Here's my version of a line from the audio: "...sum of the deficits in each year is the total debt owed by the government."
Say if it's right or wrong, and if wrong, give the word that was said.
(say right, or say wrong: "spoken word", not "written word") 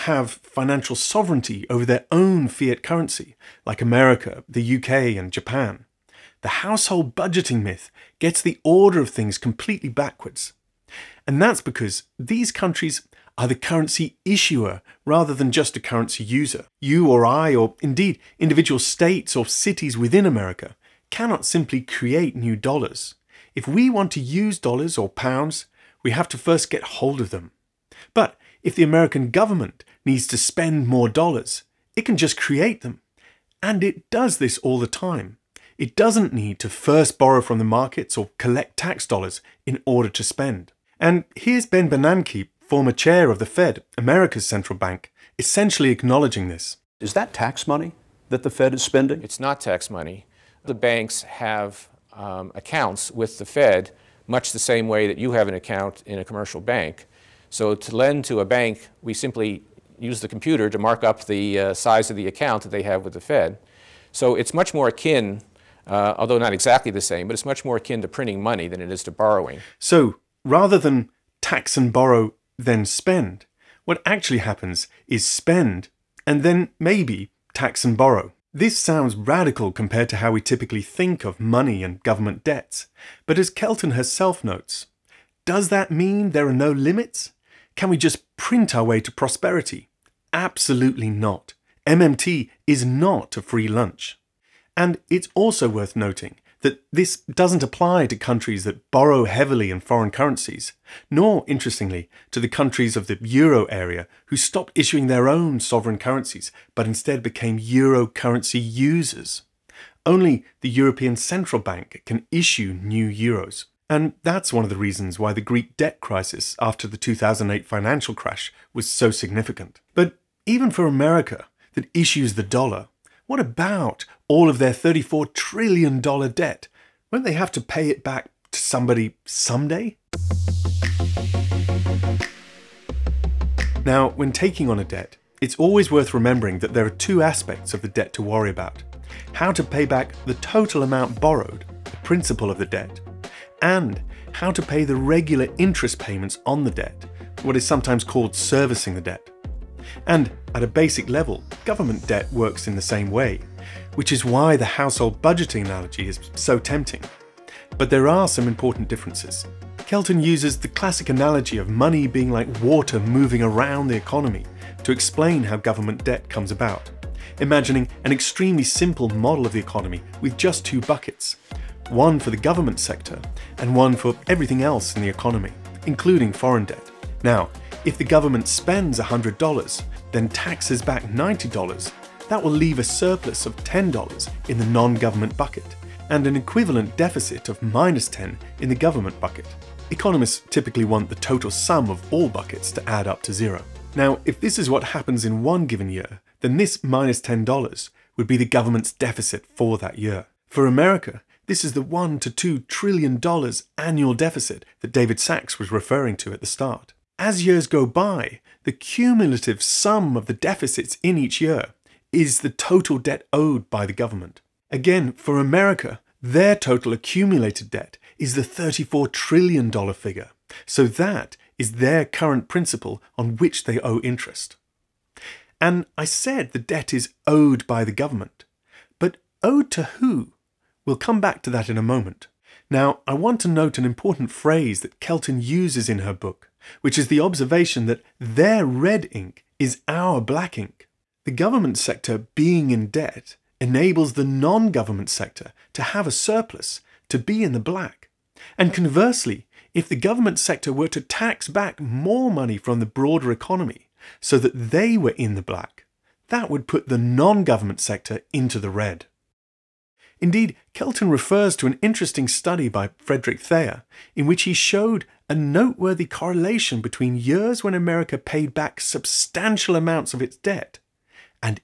right.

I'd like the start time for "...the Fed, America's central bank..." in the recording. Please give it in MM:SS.
00:43.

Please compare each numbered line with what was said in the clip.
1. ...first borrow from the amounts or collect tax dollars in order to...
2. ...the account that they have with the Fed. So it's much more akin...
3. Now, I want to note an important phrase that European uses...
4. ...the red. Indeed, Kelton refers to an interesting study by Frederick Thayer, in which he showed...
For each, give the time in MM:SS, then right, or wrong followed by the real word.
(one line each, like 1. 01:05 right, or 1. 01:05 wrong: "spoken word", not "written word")
1. 00:36 wrong: "markets", not "amounts"
2. 01:02 right
3. 03:52 wrong: "Kelton", not "European"
4. 04:18 right.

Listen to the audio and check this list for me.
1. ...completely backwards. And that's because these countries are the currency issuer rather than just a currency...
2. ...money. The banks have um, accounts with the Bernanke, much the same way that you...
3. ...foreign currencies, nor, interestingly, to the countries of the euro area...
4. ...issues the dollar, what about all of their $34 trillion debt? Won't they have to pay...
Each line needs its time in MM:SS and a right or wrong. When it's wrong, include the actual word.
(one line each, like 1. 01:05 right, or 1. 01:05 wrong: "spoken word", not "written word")
1. 00:09 right
2. 00:49 wrong: "Fed", not "Bernanke"
3. 01:39 right
4. 02:01 right.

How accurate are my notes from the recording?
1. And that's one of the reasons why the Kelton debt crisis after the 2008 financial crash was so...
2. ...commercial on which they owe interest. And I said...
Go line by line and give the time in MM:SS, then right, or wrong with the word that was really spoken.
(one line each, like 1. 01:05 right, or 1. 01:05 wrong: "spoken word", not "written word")
1. 01:53 wrong: "Greek", not "Kelton"
2. 03:42 wrong: "principal", not "commercial".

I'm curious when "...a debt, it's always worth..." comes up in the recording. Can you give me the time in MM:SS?
02:14.